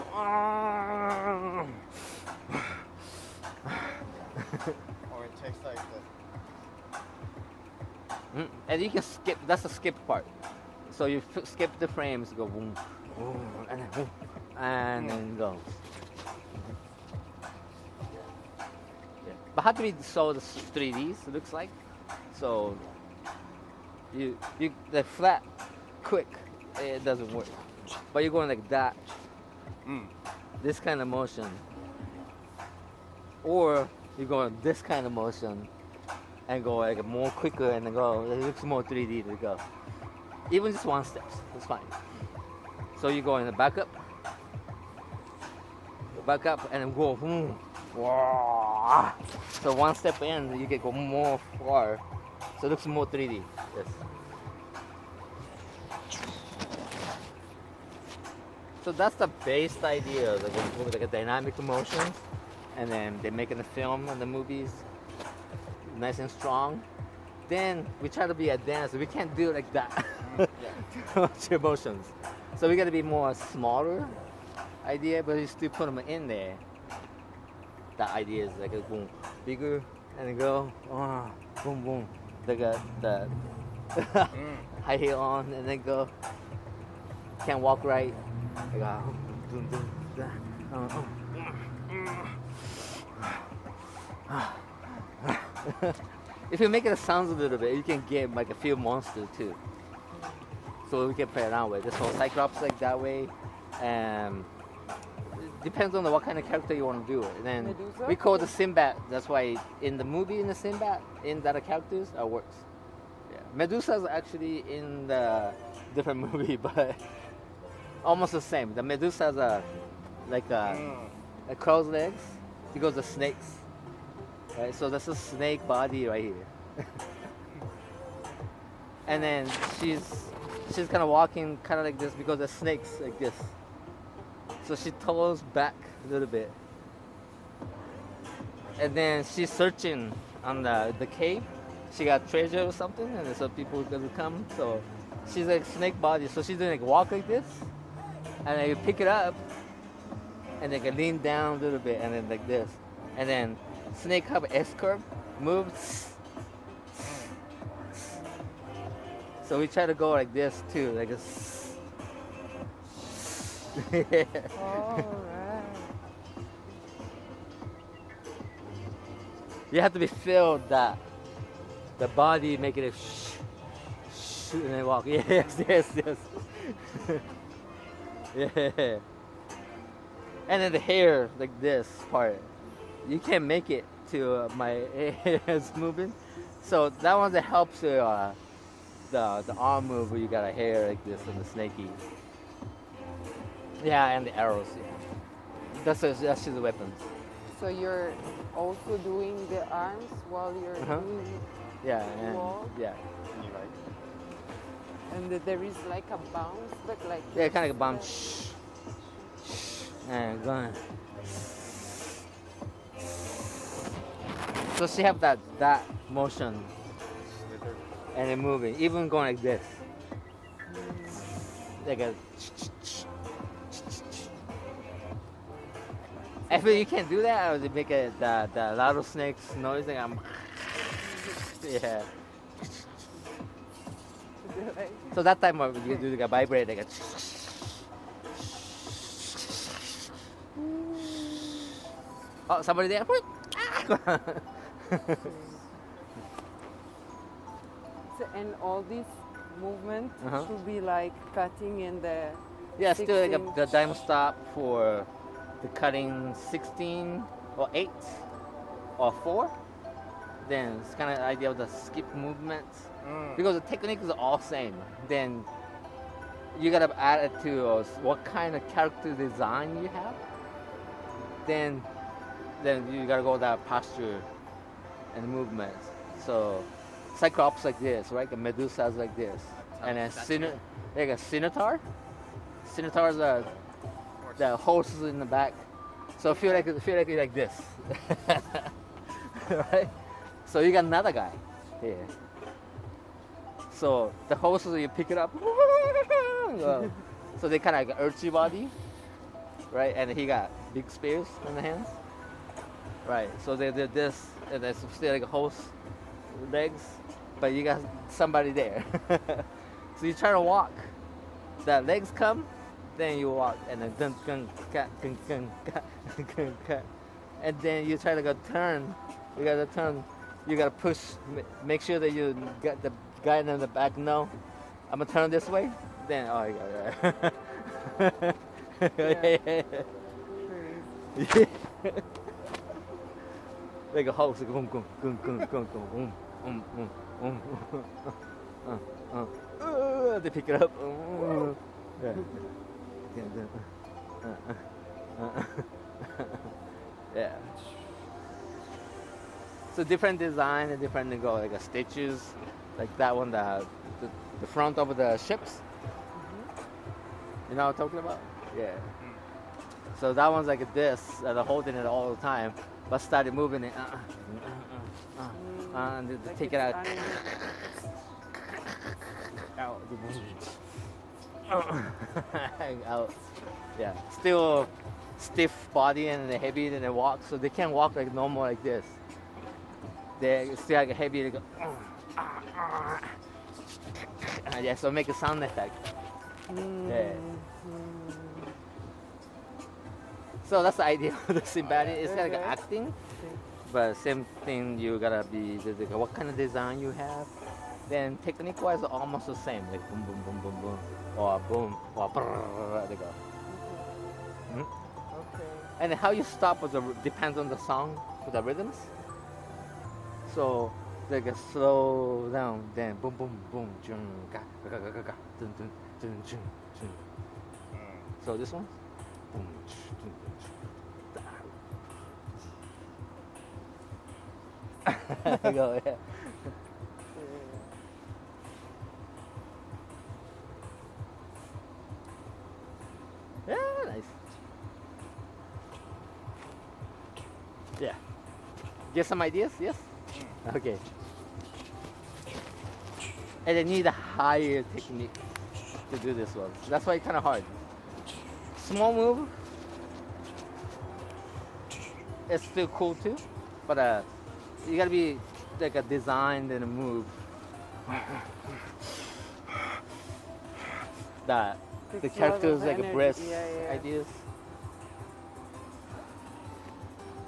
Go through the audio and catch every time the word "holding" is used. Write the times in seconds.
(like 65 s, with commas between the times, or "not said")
361 s.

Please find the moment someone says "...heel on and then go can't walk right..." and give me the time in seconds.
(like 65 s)
84 s.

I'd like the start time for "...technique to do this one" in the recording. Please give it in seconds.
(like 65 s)
444 s.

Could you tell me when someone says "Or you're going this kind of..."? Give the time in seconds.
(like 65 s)
33 s.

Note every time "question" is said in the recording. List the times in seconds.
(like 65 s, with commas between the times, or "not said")
not said.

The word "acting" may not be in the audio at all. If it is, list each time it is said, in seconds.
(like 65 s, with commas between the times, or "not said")
392 s.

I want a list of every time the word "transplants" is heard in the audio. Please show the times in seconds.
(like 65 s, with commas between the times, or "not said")
not said.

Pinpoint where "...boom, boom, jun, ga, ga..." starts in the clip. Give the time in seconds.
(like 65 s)
413 s.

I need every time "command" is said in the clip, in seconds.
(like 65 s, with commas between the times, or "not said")
not said.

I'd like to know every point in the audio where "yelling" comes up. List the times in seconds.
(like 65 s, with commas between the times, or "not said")
not said.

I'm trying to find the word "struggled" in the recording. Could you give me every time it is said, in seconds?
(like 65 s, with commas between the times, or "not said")
not said.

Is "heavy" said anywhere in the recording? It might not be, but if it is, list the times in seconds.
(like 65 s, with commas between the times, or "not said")
376 s, 381 s.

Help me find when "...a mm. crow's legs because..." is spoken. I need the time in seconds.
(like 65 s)
120 s.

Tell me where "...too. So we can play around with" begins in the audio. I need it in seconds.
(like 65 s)
99 s.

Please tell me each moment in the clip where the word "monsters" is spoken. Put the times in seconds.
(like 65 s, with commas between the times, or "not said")
98 s.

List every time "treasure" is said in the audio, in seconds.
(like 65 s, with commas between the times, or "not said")
142 s.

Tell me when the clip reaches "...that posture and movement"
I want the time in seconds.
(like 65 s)
273 s.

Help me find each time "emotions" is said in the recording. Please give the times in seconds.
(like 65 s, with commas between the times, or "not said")
71 s.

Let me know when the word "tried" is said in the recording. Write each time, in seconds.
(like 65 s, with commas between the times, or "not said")
not said.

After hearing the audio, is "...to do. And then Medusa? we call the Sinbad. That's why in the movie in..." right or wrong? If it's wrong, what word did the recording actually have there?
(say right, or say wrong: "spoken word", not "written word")
right.